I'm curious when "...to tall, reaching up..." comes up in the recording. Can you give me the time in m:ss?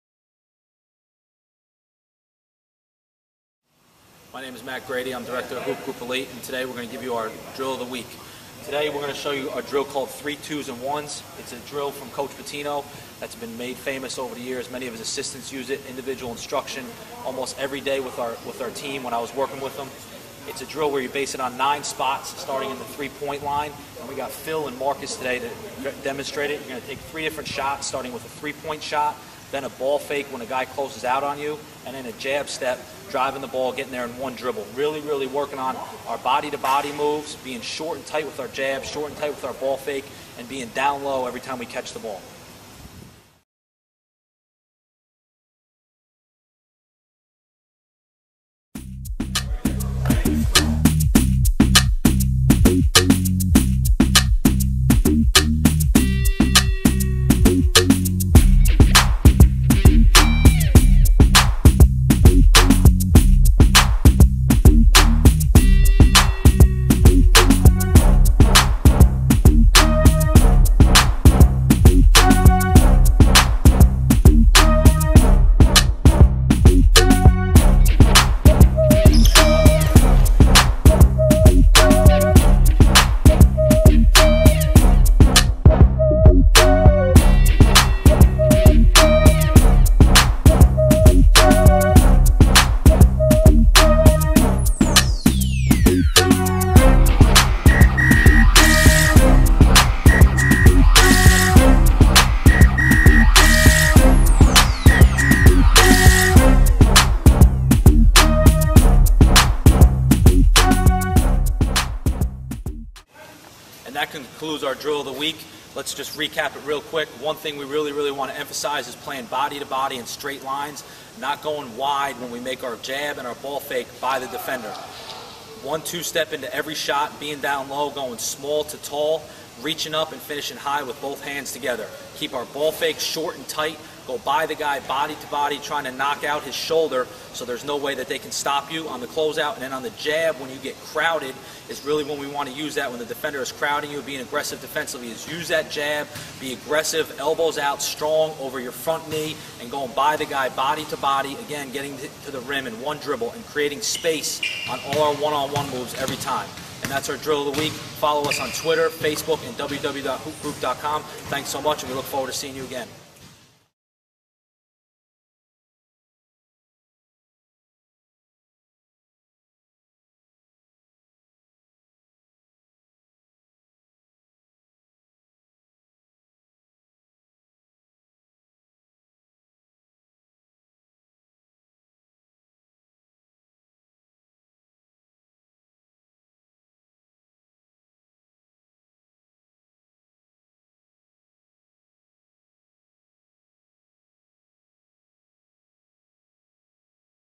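2:08.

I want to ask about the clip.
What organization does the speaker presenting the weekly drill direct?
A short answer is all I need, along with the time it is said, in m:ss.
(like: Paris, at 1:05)
Hoop Group Elite, at 0:05.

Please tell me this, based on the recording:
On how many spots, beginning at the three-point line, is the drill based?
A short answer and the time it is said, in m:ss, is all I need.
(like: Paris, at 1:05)
9, at 0:21.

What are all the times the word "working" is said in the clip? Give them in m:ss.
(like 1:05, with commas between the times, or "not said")
0:19, 0:35.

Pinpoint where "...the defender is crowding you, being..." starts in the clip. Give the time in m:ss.
2:22.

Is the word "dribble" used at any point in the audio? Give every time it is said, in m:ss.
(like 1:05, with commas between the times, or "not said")
0:34, 2:32.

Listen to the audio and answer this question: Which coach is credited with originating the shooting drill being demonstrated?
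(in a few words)
Coach Pitino.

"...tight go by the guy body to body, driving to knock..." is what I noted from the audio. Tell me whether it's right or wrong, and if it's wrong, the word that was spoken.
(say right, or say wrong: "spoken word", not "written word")
wrong: "trying", not "driving".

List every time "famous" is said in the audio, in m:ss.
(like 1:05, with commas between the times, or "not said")
0:13.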